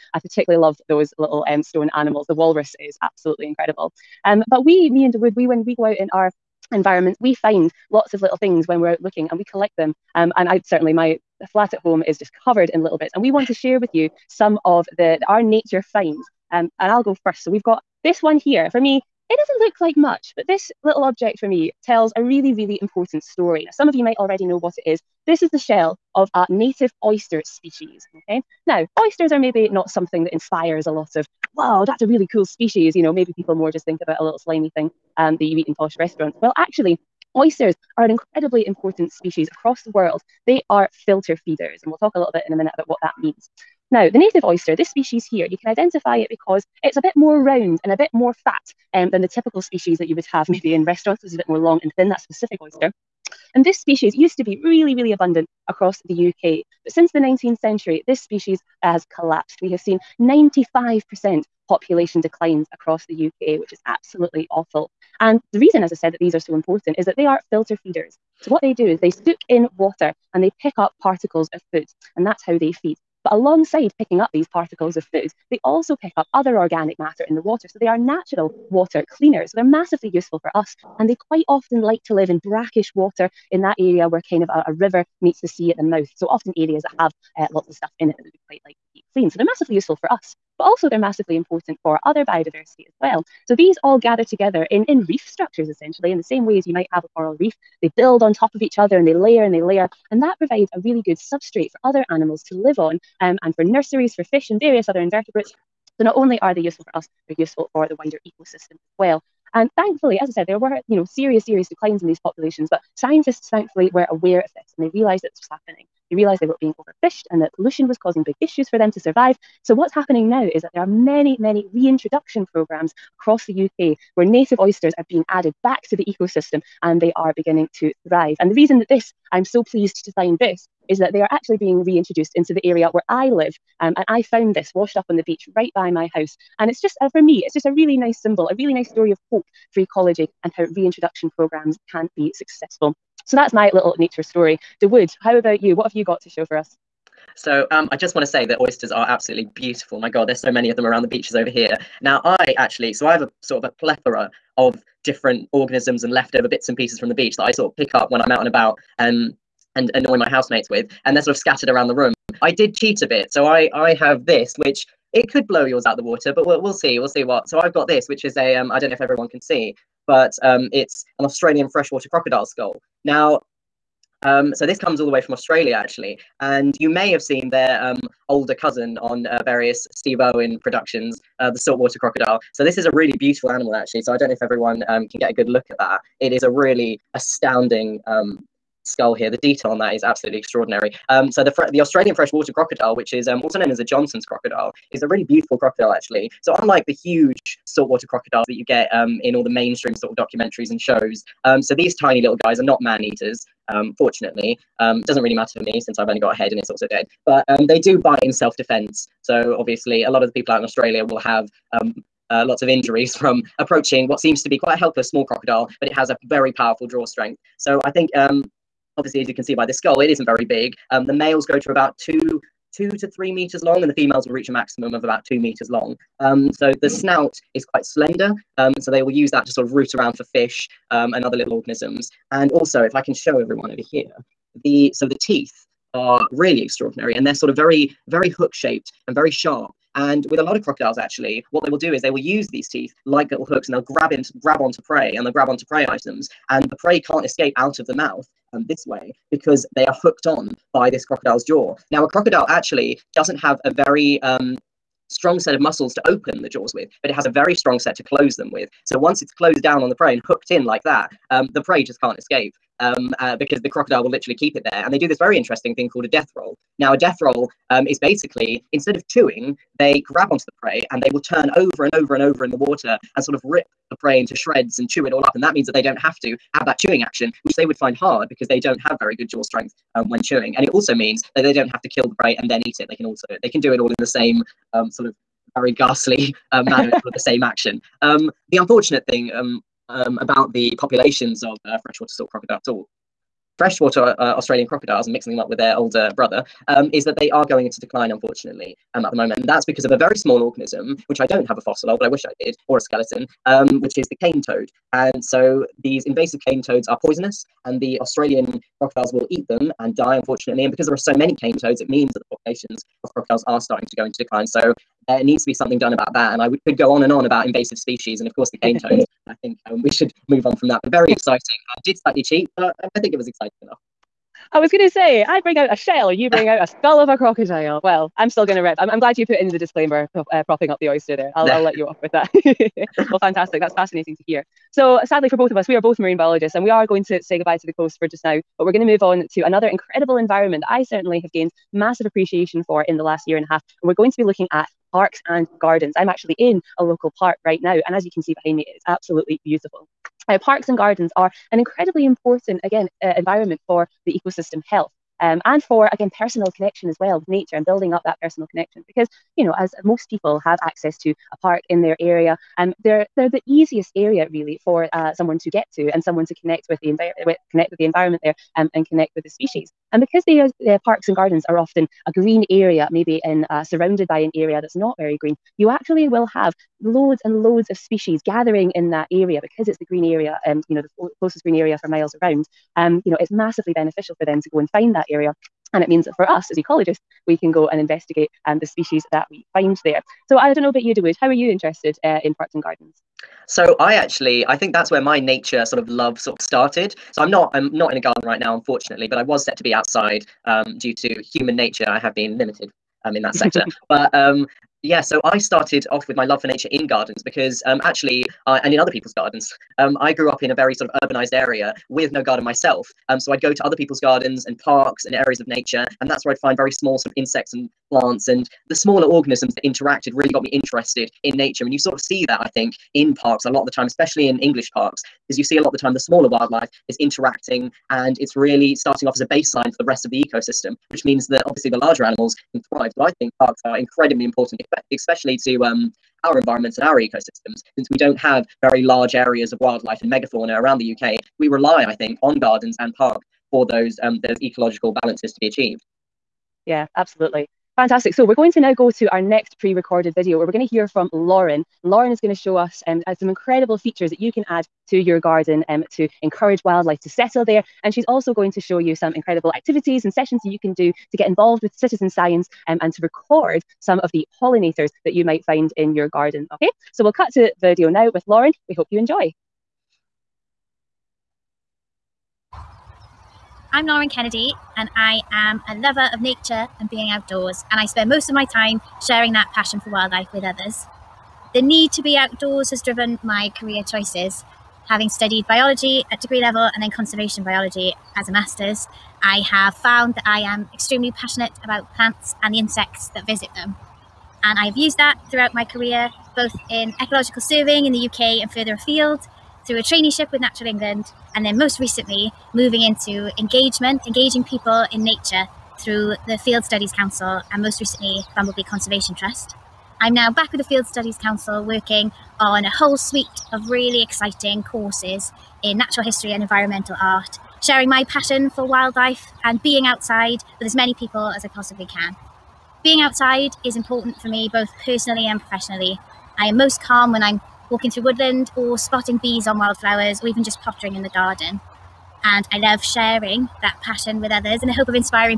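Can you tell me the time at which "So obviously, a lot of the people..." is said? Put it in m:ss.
3:29.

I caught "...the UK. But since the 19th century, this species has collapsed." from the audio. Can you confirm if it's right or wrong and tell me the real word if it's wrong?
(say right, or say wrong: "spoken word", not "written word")
right.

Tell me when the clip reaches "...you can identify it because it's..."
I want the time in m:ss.
0:45.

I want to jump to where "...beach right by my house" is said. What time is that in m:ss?
2:15.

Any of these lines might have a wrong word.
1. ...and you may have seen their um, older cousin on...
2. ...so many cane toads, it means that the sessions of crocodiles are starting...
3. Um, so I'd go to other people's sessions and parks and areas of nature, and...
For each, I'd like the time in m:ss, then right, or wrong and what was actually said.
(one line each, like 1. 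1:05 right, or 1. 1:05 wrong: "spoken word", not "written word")
1. 2:56 right
2. 5:10 wrong: "populations", not "sessions"
3. 6:53 wrong: "gardens", not "sessions".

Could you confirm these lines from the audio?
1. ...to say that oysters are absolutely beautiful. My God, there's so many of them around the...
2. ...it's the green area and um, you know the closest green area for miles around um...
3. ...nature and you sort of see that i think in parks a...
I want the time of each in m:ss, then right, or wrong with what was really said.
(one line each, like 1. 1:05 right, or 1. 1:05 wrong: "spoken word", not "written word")
1. 2:28 right
2. 6:19 right
3. 7:01 right.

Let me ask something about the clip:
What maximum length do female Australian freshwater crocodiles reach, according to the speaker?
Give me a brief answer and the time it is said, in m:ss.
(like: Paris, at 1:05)
2 meters, at 3:45.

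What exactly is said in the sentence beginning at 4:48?
Um, the unfortunate thing um, um, about the populations of uh, freshwater salt crocodile salt.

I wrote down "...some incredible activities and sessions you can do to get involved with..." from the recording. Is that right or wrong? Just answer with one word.
right.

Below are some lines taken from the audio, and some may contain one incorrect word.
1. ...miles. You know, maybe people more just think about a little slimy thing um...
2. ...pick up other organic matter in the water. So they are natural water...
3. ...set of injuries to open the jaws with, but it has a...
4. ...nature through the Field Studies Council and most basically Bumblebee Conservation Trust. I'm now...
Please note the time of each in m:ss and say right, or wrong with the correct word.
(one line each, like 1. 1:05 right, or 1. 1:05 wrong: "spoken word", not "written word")
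1. 0:32 wrong: "species", not "miles"
2. 1:15 right
3. 4:15 wrong: "muscles", not "injuries"
4. 8:25 wrong: "recently", not "basically".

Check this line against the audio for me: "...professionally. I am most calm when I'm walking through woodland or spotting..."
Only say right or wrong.
right.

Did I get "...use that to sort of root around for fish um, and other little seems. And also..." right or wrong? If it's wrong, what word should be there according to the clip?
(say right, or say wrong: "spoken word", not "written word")
wrong: "organisms", not "seems".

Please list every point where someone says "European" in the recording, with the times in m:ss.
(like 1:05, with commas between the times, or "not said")
not said.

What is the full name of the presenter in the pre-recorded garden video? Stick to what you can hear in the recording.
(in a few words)
Lauren Kennedy.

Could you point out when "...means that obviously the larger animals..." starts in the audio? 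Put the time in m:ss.
7:11.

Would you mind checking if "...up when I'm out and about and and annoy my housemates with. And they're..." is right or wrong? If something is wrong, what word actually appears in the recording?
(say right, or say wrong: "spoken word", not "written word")
right.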